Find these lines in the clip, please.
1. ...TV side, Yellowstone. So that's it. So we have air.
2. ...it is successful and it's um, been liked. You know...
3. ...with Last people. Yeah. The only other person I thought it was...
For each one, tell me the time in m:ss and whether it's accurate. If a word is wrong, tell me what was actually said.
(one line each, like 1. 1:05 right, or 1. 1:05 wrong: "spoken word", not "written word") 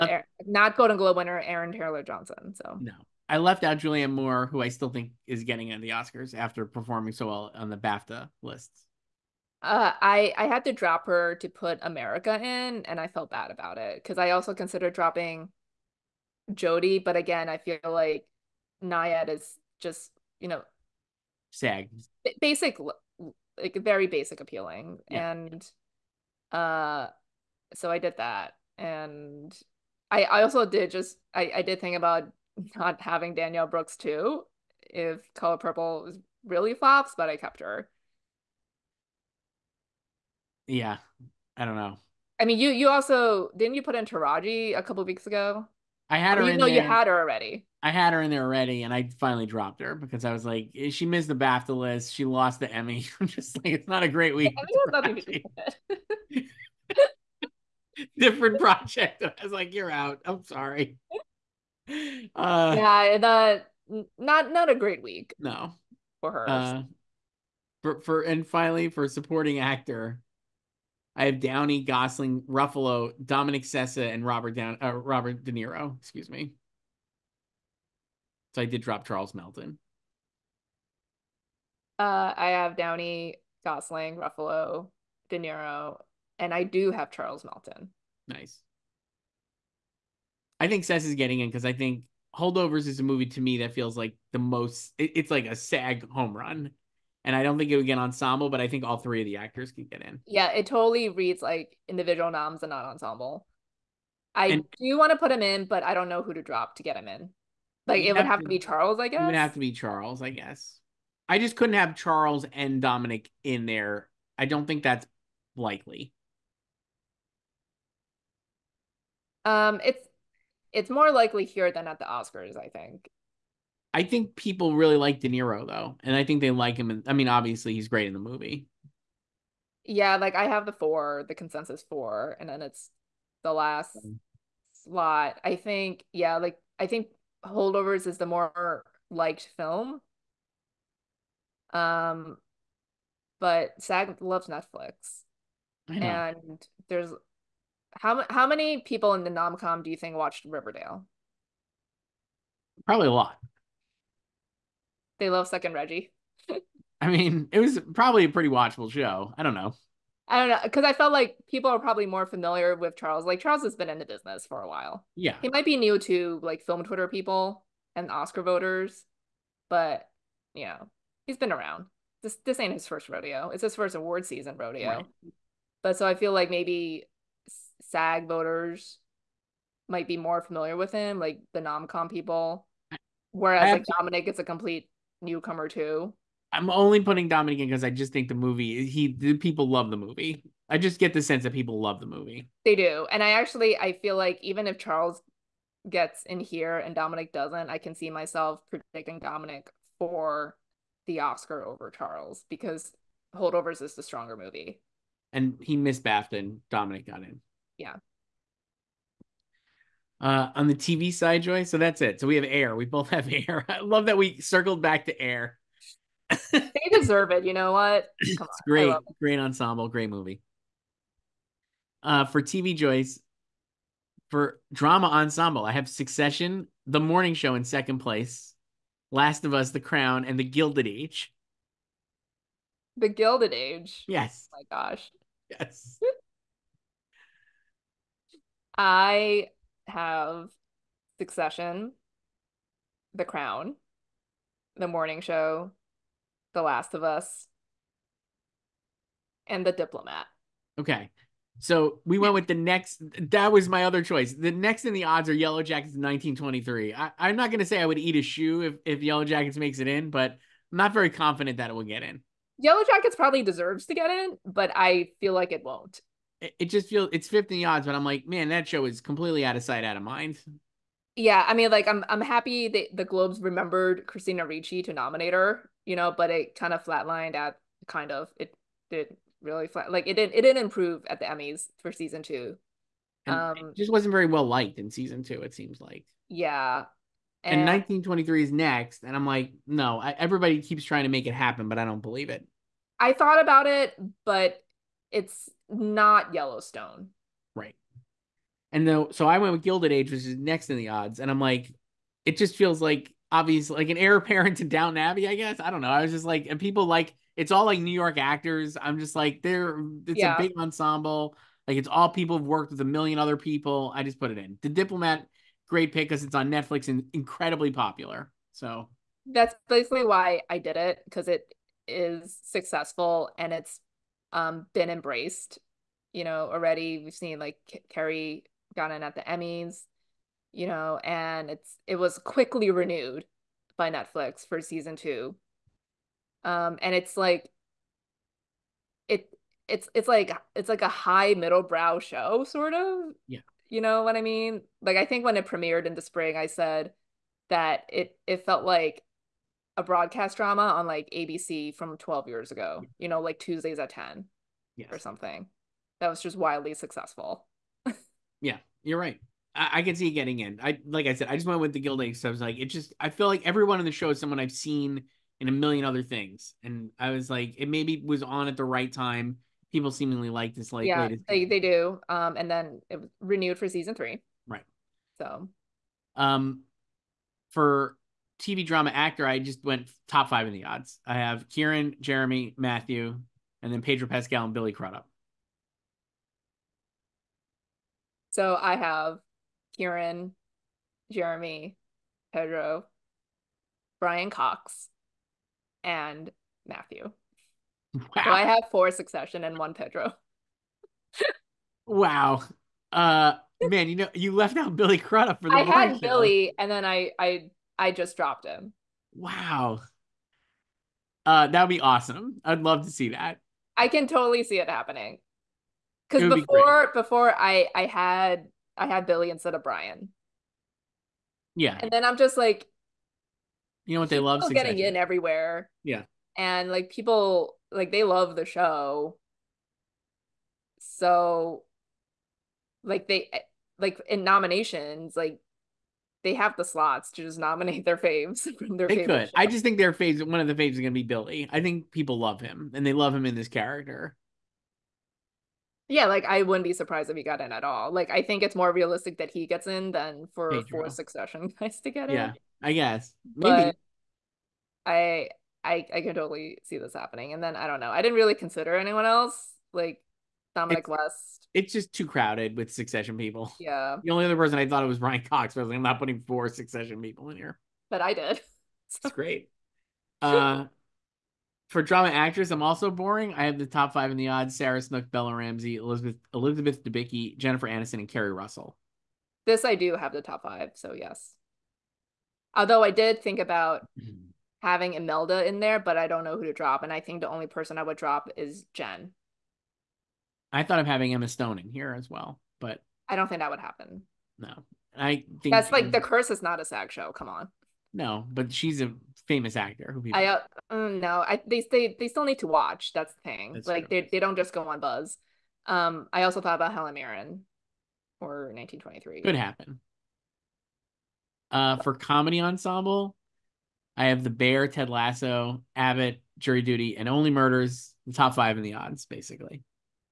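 1. 3:30 wrong: "Joy", not "Yellowstone"
2. 5:21 wrong: "embraced", not "liked"
3. 7:42 wrong: "Succession", not "Last".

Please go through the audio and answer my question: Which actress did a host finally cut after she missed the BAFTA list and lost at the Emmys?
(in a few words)
Taraji.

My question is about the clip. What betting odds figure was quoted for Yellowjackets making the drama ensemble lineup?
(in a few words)
15.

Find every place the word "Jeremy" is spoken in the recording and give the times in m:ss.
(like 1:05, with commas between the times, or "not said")
6:21, 6:31.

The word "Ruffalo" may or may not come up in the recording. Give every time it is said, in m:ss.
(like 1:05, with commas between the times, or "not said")
1:12, 1:24.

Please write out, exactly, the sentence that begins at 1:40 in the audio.
Yeah, it totally reads like individual noms and not ensemble.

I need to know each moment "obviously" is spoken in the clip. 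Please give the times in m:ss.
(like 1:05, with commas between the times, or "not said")
2:07, 5:03.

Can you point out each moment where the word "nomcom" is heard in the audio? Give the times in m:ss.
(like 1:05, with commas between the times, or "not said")
2:29, 3:01.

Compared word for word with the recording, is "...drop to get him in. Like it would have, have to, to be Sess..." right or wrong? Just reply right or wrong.
wrong.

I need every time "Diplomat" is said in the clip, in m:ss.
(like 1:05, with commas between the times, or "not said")
4:09, 5:14.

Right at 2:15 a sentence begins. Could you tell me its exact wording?
I think, yeah, like I think Holdovers is the more liked film.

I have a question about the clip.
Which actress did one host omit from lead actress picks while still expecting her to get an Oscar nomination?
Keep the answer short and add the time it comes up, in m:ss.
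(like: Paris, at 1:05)
Julianne Moore, at 0:03.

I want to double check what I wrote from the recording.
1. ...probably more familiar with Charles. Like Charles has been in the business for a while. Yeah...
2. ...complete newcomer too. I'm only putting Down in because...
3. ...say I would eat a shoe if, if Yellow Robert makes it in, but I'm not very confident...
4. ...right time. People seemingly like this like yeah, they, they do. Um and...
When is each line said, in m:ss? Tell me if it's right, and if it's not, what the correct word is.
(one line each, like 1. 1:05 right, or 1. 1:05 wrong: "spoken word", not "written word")
1. 2:41 right
2. 3:04 wrong: "Dominic", not "Down"
3. 4:17 wrong: "Jackets", not "Robert"
4. 6:08 right.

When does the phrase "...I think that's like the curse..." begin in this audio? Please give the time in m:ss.
8:14.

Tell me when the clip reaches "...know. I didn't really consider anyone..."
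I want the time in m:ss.
7:37.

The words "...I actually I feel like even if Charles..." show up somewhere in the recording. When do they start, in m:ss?
3:13.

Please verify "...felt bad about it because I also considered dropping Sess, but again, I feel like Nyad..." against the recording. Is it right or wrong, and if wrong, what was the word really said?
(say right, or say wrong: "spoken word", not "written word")
wrong: "Jodie", not "Sess".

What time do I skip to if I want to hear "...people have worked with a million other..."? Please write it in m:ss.
5:12.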